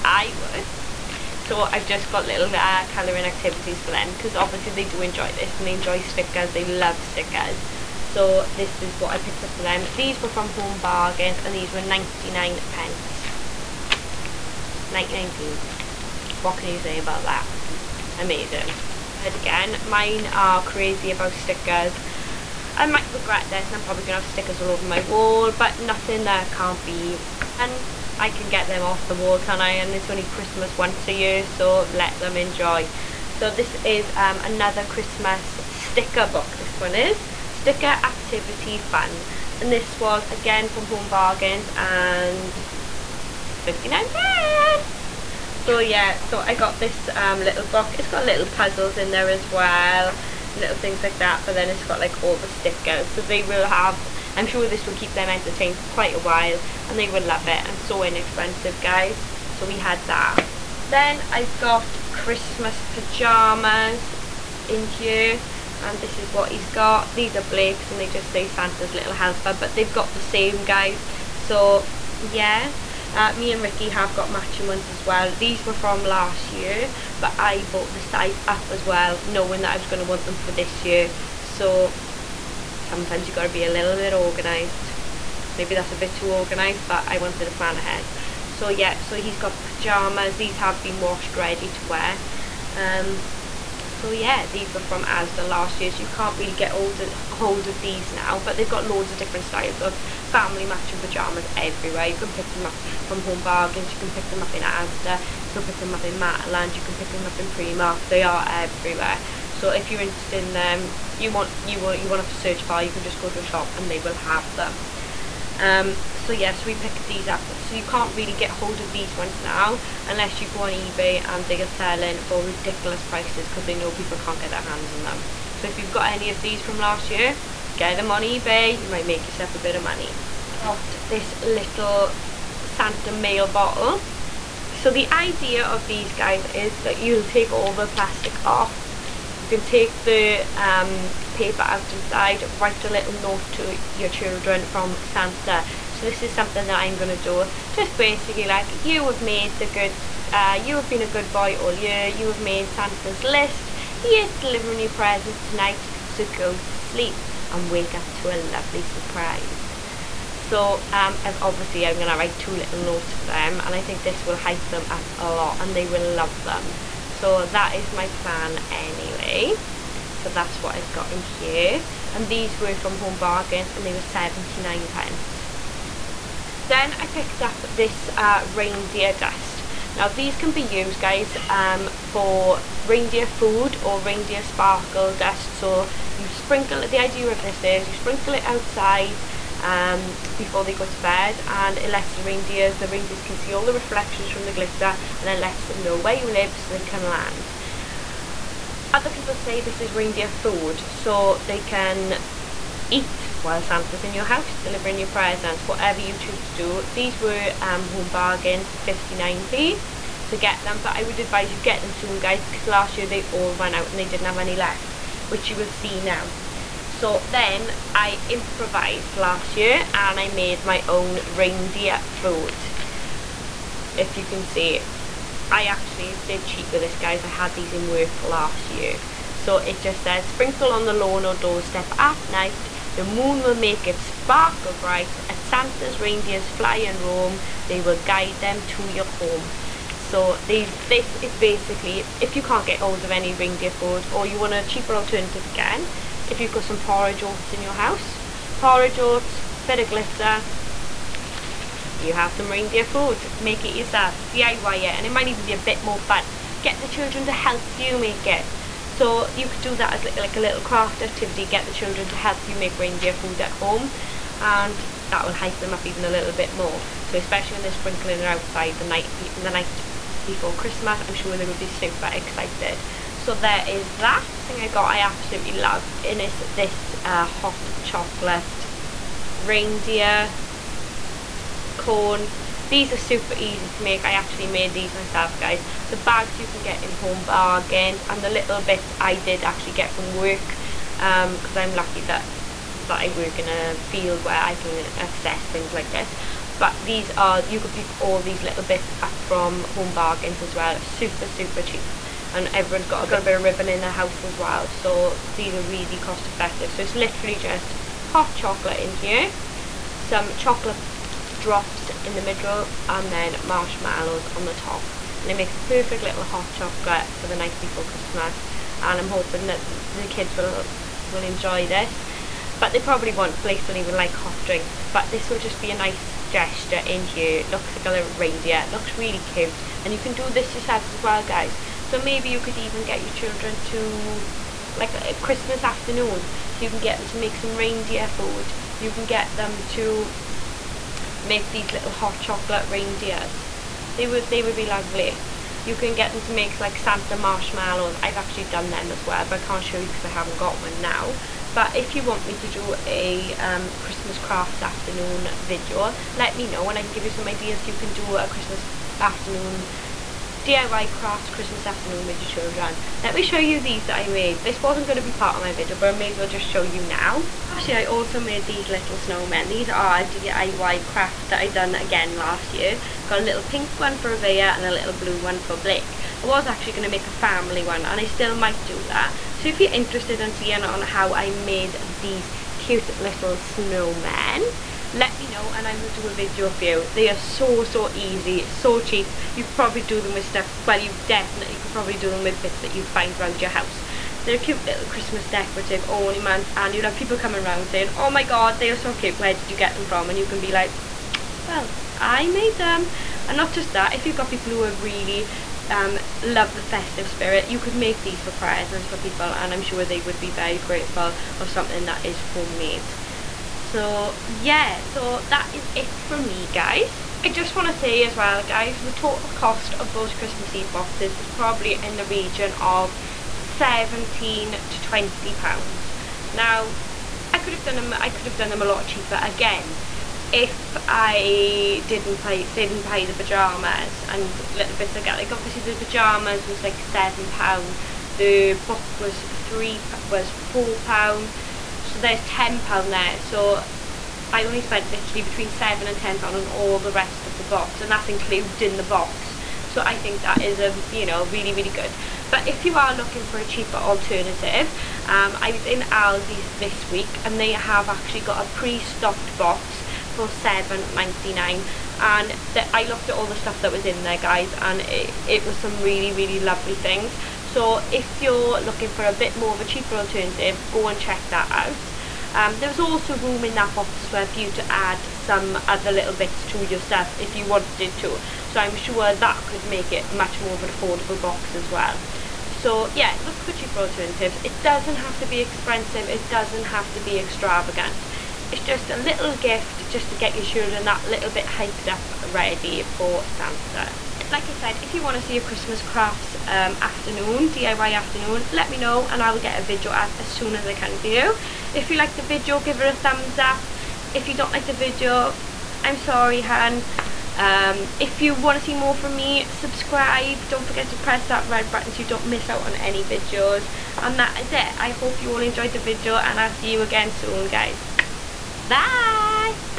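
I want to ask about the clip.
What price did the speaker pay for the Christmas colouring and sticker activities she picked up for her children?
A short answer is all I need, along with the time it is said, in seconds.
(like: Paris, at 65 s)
99p, at 11 s.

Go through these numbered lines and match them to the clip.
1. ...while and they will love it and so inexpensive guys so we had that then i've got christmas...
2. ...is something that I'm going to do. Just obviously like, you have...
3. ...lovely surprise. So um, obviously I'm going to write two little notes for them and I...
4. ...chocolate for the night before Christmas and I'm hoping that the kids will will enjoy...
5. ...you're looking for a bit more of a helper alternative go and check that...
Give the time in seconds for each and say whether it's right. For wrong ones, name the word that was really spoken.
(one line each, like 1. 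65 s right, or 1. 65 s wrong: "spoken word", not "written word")
1. 56 s right
2. 146 s wrong: "basically", not "obviously"
3. 158 s right
4. 316 s right
5. 468 s wrong: "cheaper", not "helper".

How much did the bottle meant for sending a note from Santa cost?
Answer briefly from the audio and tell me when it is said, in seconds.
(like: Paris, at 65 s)
79p, at 174 s.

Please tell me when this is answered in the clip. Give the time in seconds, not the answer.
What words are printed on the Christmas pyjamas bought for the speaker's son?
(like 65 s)
68 s.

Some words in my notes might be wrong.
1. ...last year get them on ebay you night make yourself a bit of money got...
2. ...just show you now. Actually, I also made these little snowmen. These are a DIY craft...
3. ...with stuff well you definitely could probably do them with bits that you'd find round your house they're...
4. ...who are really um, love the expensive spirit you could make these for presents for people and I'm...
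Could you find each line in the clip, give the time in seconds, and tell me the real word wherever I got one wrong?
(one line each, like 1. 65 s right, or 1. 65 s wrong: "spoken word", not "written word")
1. 126 s wrong: "might", not "night"
2. 366 s right
3. 390 s right
4. 404 s wrong: "festive", not "expensive".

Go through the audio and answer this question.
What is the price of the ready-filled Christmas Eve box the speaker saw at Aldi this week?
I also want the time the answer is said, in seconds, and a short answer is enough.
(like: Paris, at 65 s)
£7.99, at 460 s.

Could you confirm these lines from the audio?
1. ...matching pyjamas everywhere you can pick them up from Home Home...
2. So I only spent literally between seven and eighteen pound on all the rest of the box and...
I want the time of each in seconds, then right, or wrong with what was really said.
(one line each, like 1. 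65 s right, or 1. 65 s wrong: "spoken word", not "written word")
1. 100 s wrong: "Bargains", not "Home"
2. 443 s wrong: "ten", not "eighteen".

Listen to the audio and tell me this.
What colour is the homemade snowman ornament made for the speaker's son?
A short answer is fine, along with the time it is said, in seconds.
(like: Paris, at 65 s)
Blue, at 374 s.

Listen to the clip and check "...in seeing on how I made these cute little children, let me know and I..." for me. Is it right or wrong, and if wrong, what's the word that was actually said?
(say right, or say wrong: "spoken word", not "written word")
wrong: "snowmen", not "children".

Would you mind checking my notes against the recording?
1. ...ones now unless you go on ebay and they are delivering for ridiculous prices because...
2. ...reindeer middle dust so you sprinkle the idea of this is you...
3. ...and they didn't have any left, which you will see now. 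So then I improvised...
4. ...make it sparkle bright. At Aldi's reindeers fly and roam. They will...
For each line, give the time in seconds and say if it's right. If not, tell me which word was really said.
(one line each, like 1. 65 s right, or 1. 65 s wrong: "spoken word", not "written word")
1. 119 s wrong: "selling", not "delivering"
2. 184 s wrong: "sparkle", not "middle"
3. 213 s right
4. 233 s wrong: "Santa", not "Aldi".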